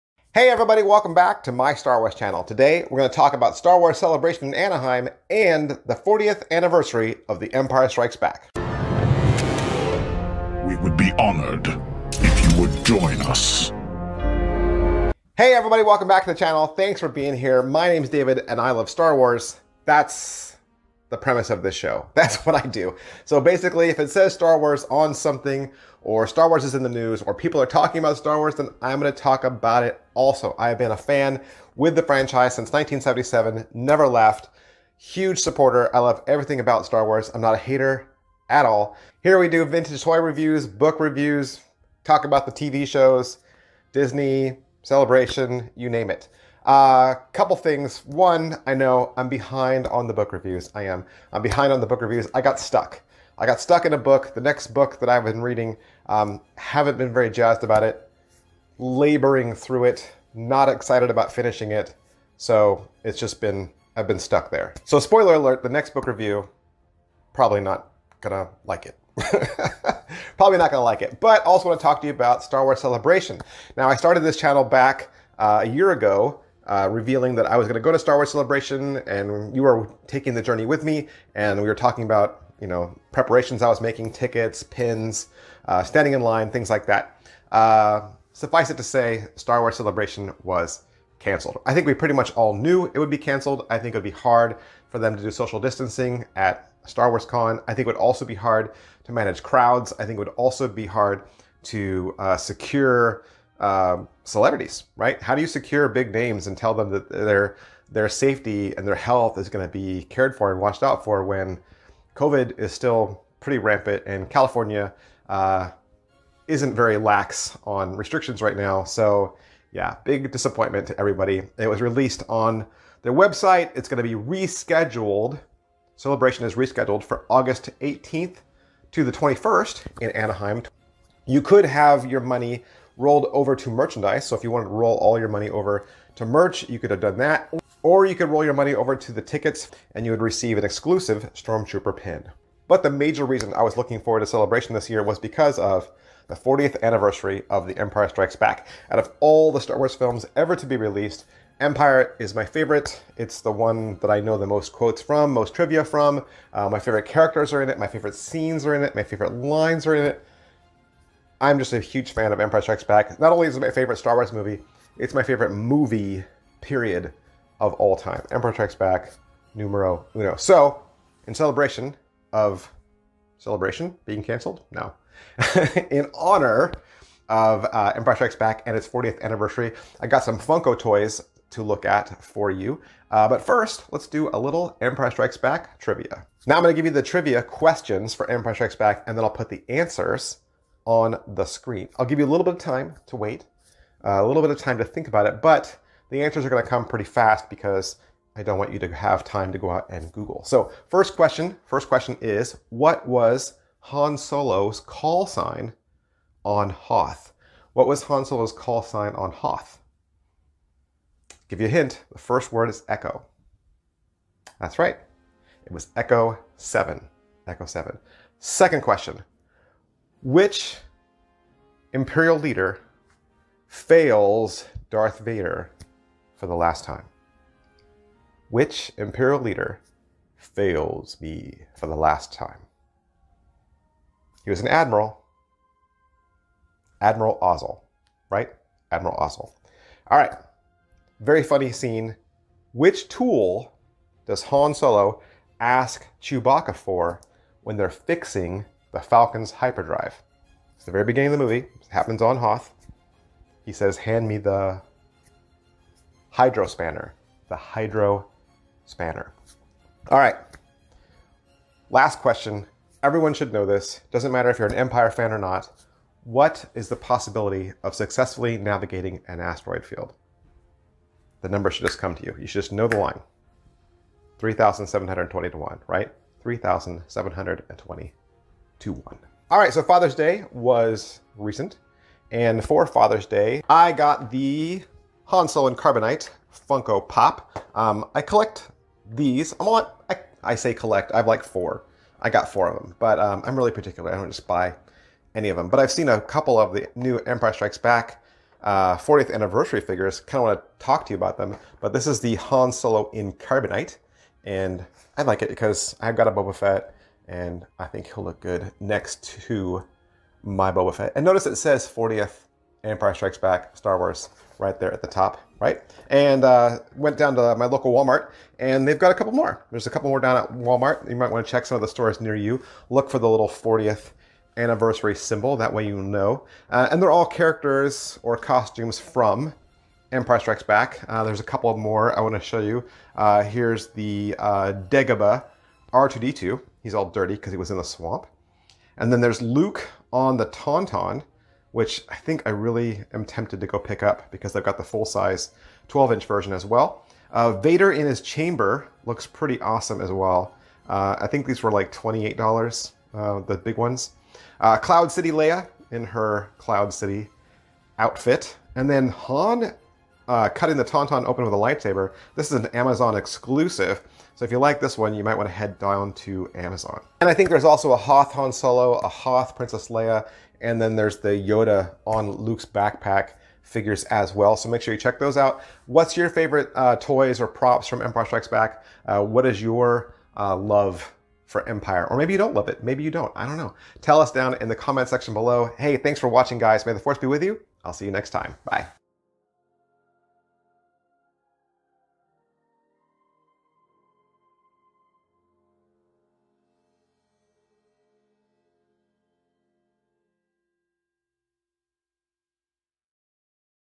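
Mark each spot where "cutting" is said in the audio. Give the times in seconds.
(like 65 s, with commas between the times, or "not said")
360 s.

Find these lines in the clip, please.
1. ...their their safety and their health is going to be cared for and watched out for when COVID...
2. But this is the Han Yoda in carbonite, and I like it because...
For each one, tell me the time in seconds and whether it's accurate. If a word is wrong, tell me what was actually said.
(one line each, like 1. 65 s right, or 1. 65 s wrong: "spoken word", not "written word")
1. 107 s right
2. 301 s wrong: "Solo", not "Yoda".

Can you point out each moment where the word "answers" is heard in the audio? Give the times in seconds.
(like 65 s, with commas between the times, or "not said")
189 s, 196 s.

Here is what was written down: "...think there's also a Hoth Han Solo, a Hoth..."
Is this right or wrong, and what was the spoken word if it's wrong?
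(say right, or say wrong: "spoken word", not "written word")
right.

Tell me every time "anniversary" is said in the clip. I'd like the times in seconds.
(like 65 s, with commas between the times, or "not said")
6 s, 146 s, 179 s, 299 s, 324 s.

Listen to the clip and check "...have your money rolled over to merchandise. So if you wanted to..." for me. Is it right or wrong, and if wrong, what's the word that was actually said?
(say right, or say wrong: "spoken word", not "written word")
right.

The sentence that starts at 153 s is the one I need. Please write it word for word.
It's the one that I know the most quotes from, most trivia from.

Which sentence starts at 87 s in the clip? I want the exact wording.
Uh, Suffice it to say, Star Wars Celebration was canceled.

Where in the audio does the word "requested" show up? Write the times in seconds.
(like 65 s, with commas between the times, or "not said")
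not said.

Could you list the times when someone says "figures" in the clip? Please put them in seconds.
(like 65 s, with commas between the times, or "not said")
299 s, 373 s.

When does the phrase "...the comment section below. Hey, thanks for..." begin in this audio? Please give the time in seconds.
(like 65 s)
384 s.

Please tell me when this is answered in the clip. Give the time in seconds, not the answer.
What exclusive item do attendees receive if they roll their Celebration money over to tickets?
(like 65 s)
141 s.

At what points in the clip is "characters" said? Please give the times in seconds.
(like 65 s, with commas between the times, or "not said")
157 s, 327 s.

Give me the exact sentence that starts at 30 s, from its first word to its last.
I have been a fan with the franchise since 1977, never left.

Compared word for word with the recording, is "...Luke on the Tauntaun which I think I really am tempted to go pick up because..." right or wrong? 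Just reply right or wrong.
right.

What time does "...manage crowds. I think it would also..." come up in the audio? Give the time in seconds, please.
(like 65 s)
99 s.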